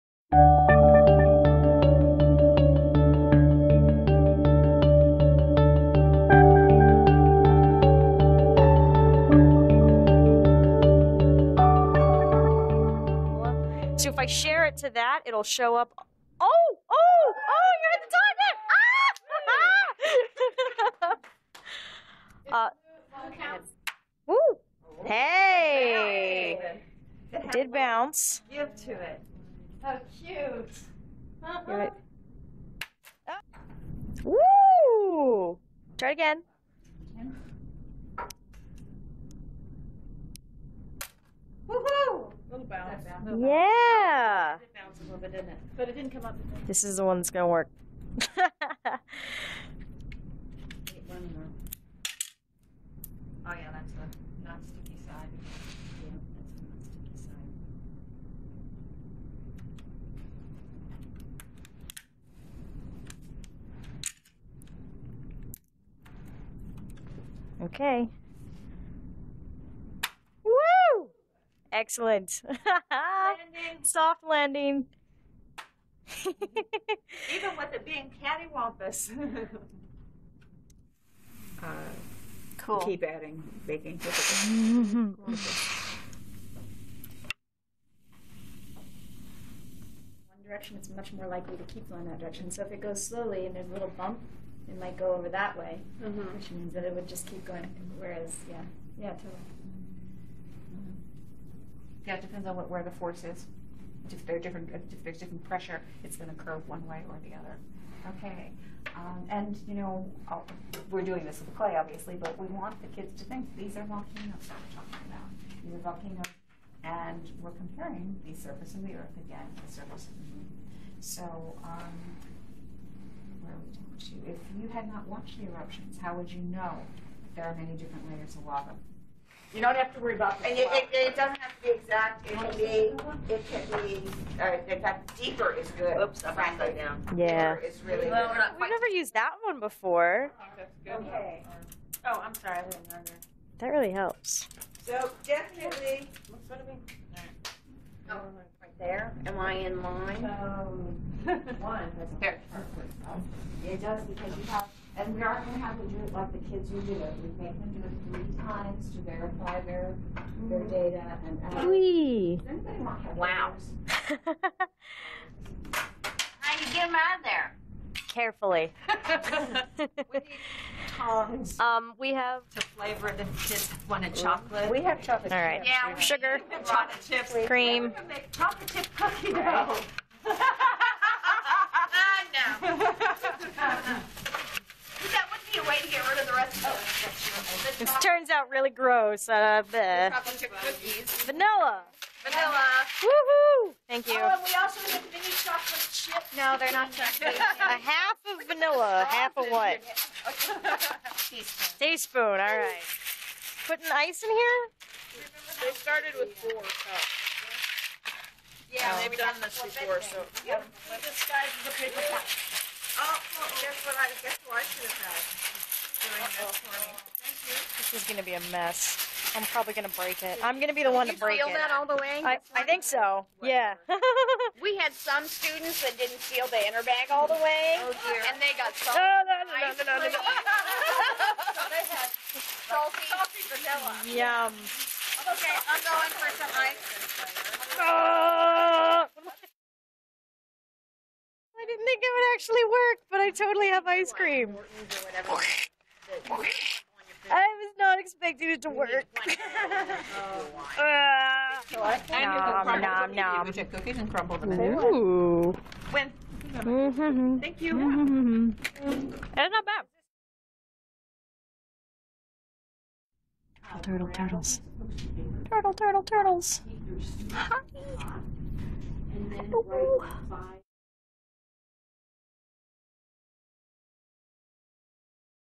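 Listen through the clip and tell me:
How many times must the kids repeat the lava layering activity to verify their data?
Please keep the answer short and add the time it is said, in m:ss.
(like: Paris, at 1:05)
3, at 2:38.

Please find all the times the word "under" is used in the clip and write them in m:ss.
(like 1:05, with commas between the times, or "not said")
2:22.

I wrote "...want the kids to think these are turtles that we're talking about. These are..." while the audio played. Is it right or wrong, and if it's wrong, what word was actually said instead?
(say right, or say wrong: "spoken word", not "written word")
wrong: "volcanoes", not "turtles".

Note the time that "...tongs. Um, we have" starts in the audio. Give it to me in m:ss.
2:50.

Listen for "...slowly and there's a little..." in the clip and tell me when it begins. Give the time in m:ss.
1:33.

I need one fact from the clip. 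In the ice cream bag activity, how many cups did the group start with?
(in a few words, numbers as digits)
4.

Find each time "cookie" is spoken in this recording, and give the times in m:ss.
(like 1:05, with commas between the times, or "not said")
2:58, 4:13.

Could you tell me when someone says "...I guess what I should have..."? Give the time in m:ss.
3:33.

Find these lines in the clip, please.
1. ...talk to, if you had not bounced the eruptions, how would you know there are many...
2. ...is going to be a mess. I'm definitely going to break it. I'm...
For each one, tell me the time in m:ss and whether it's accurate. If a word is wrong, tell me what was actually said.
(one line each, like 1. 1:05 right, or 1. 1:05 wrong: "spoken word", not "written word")
1. 2:03 wrong: "watched", not "bounced"
2. 3:37 wrong: "probably", not "definitely".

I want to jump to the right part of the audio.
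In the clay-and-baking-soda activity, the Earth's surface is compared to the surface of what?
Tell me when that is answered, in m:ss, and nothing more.
2:00.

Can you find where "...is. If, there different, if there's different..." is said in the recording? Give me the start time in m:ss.
1:43.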